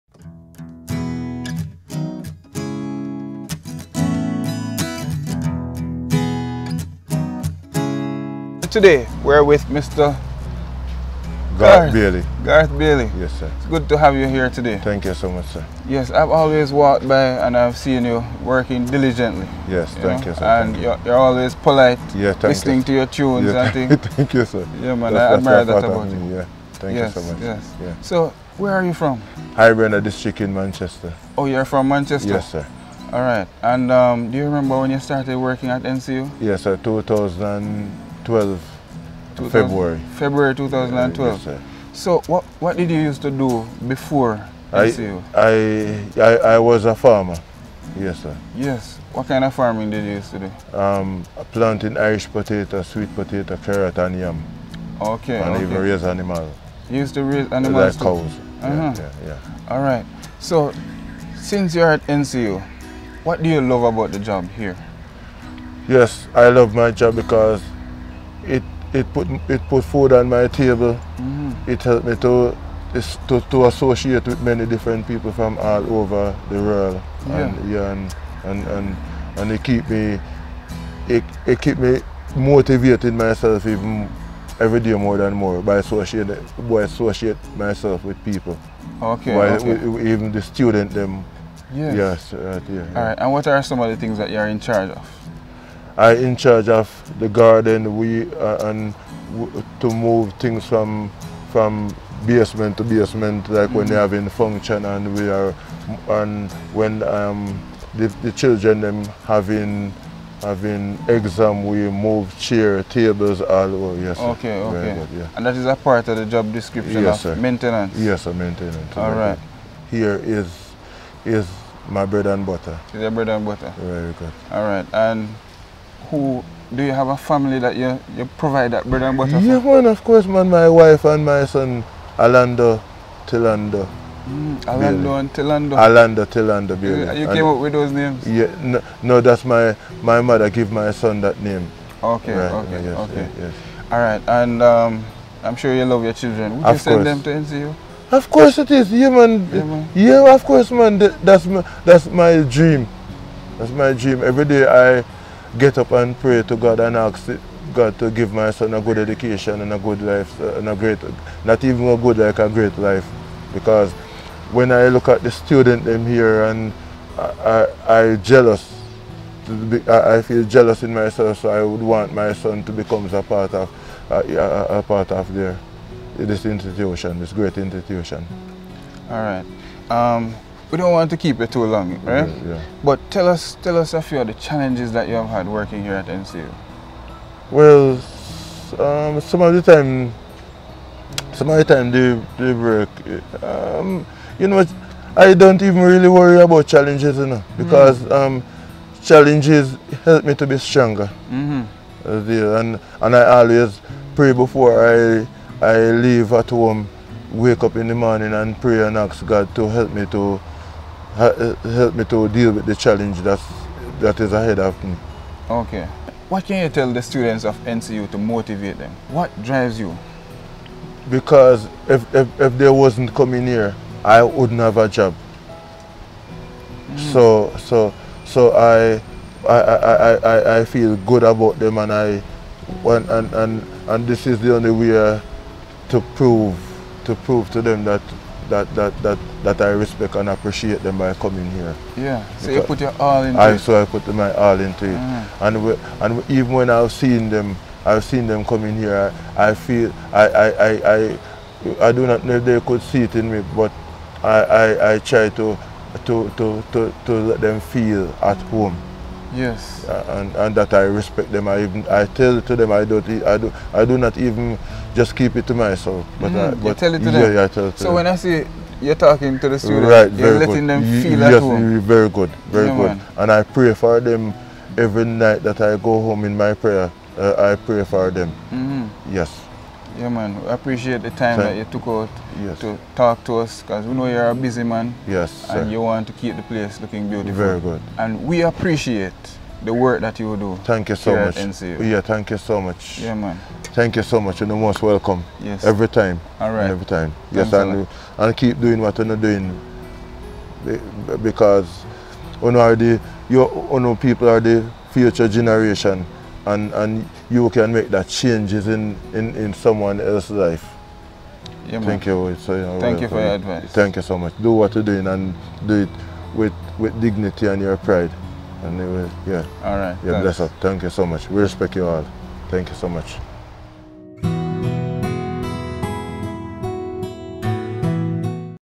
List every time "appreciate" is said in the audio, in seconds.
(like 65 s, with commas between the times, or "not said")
240 s, 280 s, 288 s.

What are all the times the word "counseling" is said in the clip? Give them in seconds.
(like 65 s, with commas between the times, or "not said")
not said.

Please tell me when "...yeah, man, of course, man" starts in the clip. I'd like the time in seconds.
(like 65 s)
129 s.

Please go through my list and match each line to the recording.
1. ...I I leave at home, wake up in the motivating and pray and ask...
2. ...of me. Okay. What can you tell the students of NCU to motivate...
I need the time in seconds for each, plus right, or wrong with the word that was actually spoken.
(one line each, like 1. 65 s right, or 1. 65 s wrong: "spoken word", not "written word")
1. 204 s wrong: "morning", not "motivating"
2. 214 s right.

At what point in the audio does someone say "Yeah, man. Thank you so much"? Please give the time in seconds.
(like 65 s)
292 s.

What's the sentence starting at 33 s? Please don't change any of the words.
And um, do you remember when you started working at NCU?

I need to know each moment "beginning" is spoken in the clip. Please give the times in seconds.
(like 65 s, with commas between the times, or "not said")
not said.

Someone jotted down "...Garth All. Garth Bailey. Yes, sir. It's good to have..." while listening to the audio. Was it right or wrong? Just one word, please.
wrong.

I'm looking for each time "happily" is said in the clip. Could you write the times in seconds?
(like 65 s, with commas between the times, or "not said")
not said.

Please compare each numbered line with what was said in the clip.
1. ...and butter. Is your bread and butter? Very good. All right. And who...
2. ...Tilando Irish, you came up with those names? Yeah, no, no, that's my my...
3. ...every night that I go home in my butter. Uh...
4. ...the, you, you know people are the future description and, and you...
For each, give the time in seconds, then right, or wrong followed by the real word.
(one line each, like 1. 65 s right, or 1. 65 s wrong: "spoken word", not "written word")
1. 122 s right
2. 136 s wrong: "You", not "Irish"
3. 274 s wrong: "prayer", not "butter"
4. 302 s wrong: "generation", not "description".